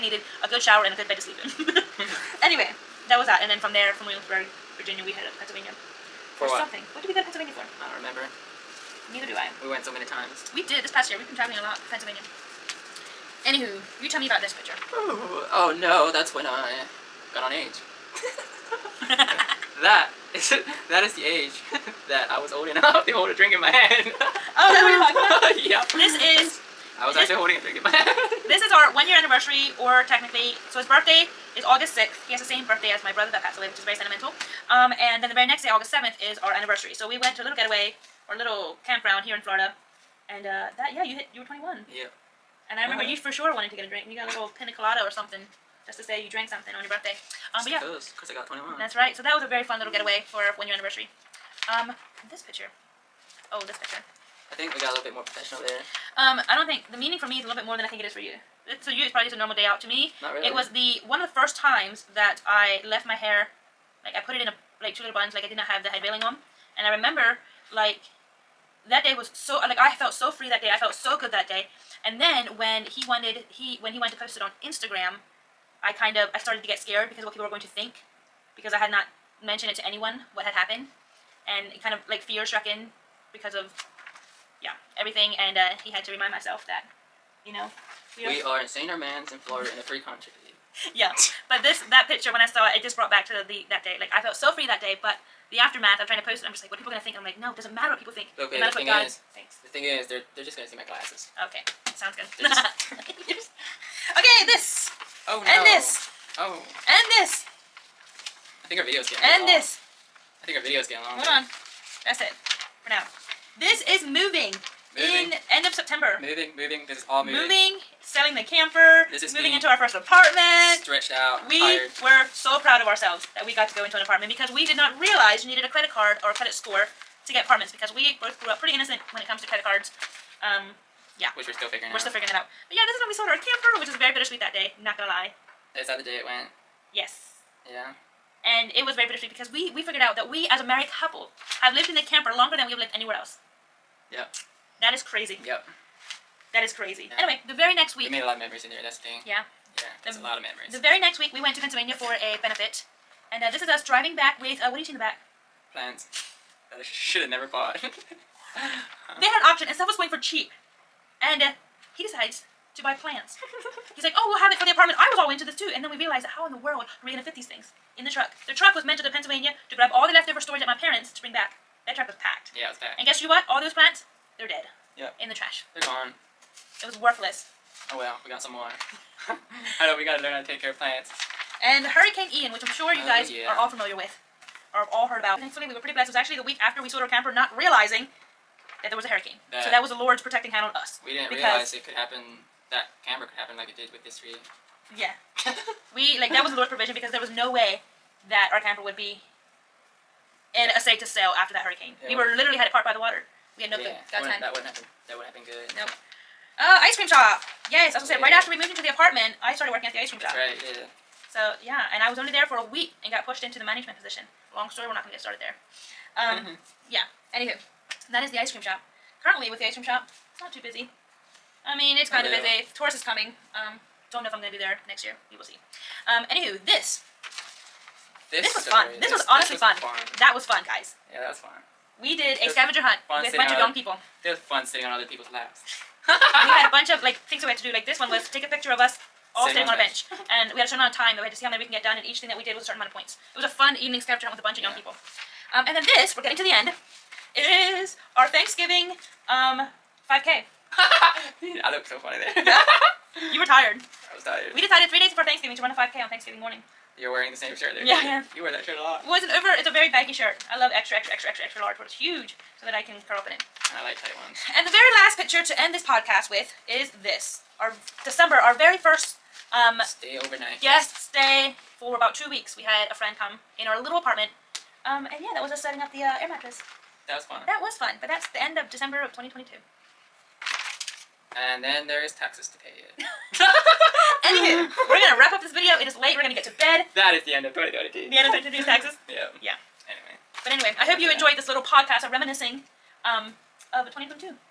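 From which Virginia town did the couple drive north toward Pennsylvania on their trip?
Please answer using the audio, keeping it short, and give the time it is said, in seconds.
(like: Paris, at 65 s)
Williamsburg, at 4 s.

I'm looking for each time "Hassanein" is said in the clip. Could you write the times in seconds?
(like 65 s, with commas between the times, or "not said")
not said.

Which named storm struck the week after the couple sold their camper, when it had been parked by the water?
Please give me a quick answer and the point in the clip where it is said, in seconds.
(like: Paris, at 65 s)
Hurricane Ian, at 181 s.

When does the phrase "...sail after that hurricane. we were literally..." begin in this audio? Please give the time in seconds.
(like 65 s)
201 s.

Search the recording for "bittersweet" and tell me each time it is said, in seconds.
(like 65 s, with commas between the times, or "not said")
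134 s, 139 s.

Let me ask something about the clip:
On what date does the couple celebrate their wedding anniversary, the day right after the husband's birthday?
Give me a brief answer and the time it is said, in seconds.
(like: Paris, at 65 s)
August 7, at 35 s.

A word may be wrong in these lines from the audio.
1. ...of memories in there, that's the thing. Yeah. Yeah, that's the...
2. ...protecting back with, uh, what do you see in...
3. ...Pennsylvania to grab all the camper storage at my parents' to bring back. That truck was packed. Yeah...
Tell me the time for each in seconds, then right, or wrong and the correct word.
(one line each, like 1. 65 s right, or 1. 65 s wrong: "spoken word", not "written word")
1. 148 s right
2. 153 s wrong: "driving", not "protecting"
3. 169 s wrong: "leftover", not "camper".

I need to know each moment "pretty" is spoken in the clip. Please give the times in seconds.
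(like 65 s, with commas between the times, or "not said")
128 s, 185 s.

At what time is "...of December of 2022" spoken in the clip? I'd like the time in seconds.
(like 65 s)
278 s.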